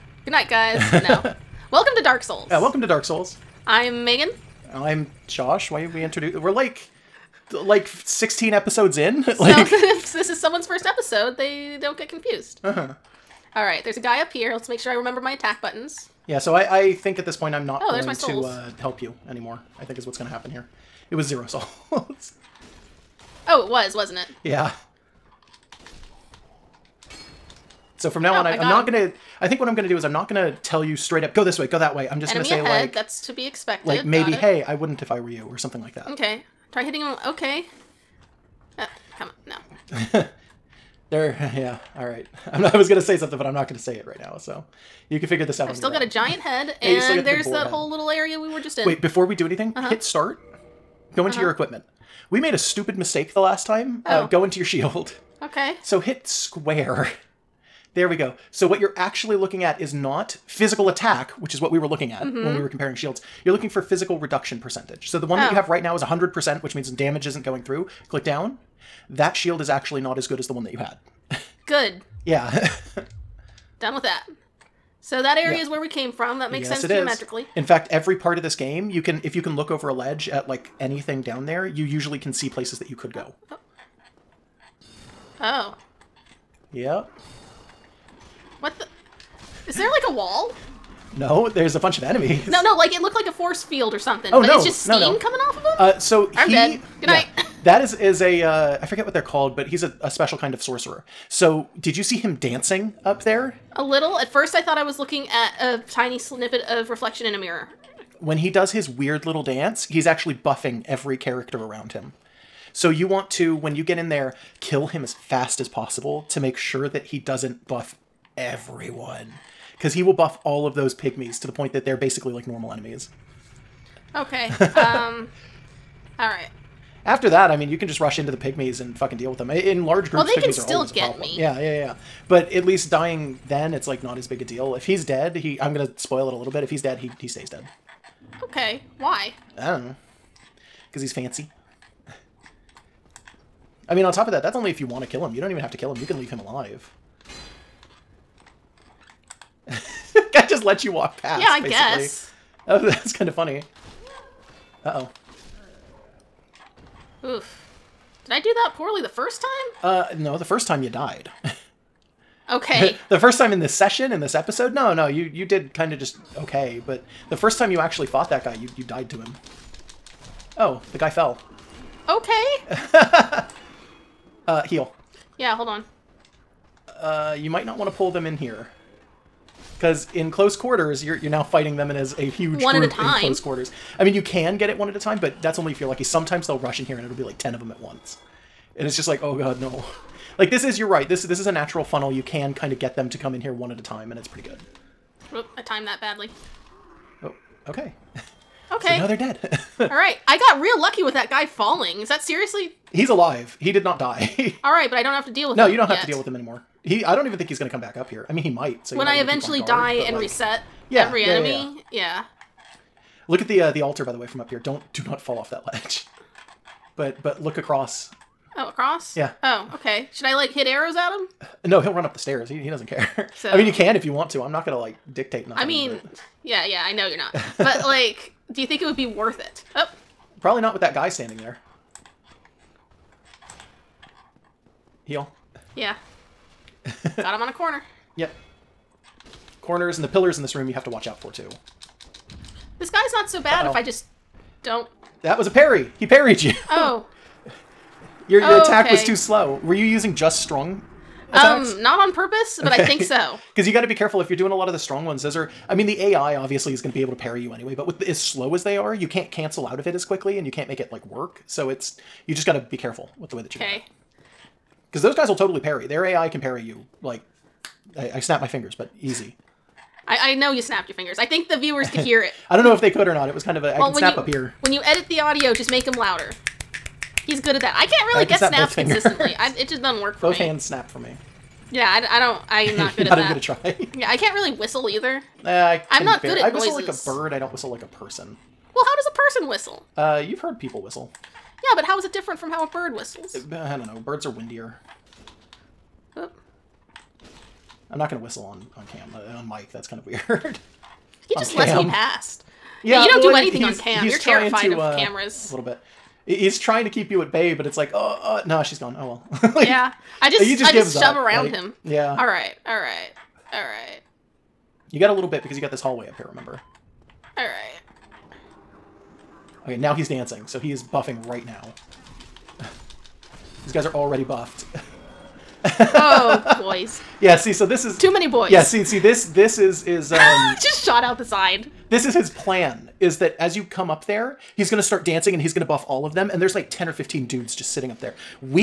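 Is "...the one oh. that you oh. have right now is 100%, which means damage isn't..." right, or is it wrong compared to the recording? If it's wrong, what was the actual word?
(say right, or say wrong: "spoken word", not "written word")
right.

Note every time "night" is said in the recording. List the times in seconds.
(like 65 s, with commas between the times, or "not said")
0 s, 97 s.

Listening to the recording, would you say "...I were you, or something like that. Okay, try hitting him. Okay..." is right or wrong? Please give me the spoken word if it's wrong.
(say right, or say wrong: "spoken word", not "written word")
right.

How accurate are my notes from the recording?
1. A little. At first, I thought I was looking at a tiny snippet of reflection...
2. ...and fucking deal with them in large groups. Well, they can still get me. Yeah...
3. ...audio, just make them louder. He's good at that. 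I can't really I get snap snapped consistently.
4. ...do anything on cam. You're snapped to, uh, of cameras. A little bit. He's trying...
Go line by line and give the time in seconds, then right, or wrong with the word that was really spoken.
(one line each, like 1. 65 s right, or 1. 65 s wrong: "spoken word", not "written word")
1. 103 s right
2. 128 s right
3. 275 s right
4. 303 s wrong: "terrified", not "snapped".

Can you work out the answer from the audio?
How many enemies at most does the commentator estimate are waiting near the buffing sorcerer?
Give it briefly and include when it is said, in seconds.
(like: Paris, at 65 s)
15, at 336 s.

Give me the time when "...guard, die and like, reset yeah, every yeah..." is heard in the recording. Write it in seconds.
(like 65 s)
209 s.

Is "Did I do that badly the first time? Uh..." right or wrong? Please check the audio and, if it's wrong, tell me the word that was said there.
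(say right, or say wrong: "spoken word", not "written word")
wrong: "poorly", not "badly".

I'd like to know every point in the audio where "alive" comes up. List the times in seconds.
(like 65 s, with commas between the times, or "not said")
146 s, 203 s.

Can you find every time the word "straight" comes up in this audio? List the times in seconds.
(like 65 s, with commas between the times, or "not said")
30 s.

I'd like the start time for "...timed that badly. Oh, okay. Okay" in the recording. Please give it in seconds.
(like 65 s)
195 s.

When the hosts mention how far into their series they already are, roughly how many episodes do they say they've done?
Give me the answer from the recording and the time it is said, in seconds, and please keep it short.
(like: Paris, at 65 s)
16, at 7 s.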